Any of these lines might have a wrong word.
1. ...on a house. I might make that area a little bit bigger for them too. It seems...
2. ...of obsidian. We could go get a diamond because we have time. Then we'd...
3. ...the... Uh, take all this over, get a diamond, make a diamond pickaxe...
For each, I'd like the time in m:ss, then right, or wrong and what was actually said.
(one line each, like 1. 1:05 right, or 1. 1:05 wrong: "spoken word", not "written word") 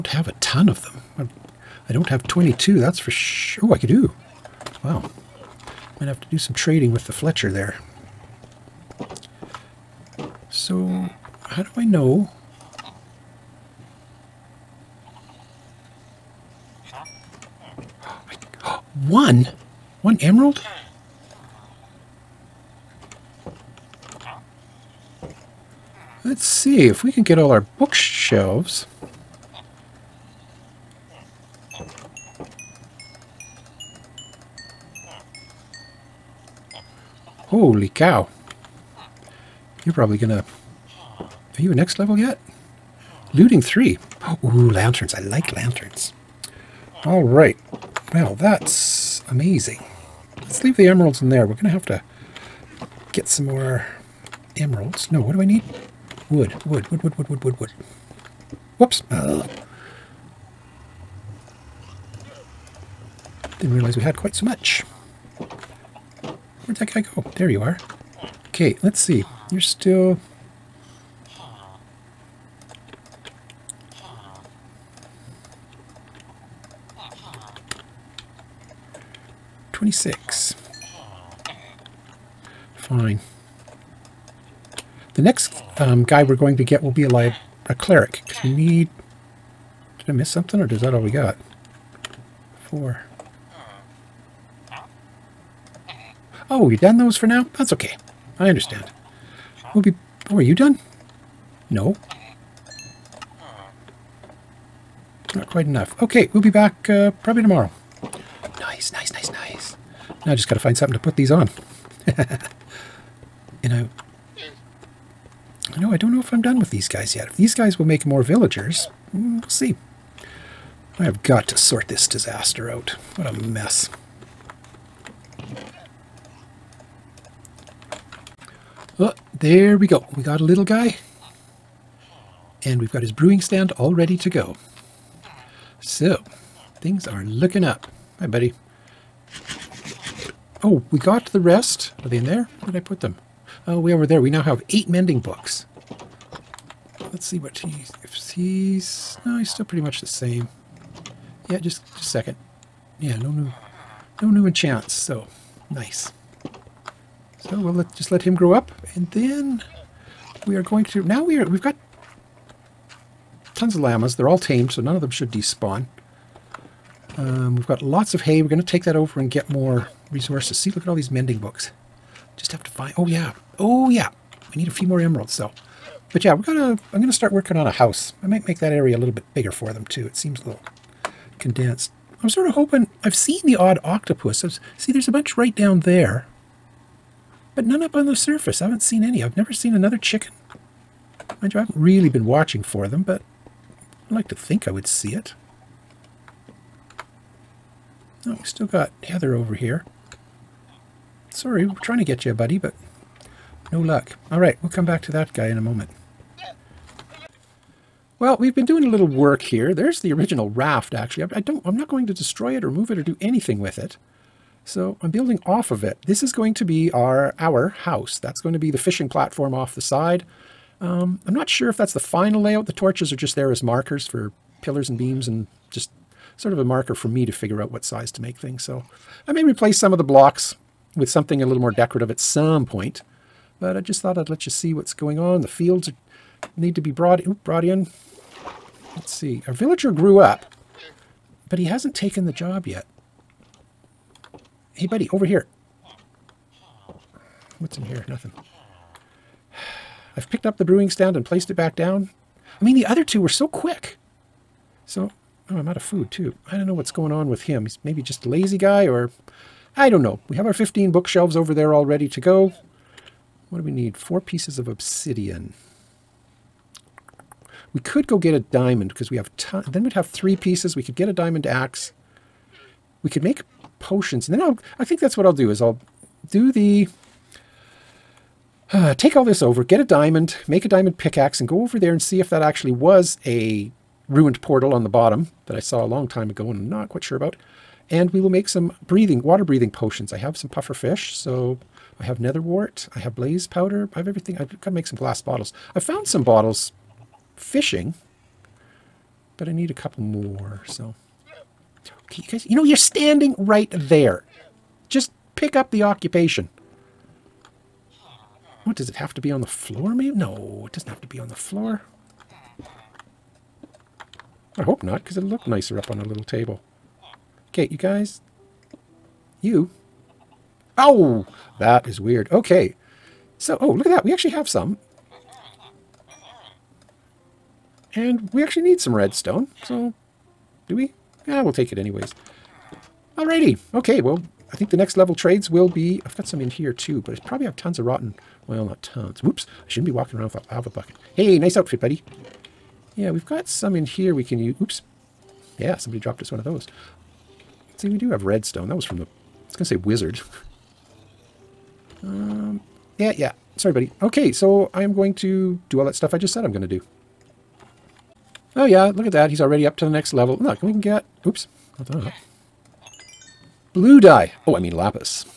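1. 2:57 right
2. 4:24 right
3. 4:36 right.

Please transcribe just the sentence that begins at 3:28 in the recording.
Well, we've been doing a little work here.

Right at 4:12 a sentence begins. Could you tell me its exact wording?
I mean, the other two were so quick.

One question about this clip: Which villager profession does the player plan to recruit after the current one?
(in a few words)
Cleric.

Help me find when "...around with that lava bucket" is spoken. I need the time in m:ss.
5:40.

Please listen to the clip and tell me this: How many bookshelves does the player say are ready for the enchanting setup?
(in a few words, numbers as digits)
15.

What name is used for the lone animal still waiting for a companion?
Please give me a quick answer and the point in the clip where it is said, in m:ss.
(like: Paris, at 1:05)
Heather, at 3:19.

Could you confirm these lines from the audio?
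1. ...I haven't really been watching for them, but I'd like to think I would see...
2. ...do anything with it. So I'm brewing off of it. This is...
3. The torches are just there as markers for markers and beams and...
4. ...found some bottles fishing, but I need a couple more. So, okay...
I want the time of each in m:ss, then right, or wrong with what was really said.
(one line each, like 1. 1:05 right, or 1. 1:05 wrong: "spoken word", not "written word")
1. 3:11 right
2. 3:33 wrong: "building", not "brewing"
3. 3:42 wrong: "pillars", not "markers"
4. 4:55 right.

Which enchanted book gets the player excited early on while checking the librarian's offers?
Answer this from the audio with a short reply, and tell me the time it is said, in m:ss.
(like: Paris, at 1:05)
Looting 3, at 0:43.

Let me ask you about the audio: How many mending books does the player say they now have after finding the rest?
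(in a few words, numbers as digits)
8.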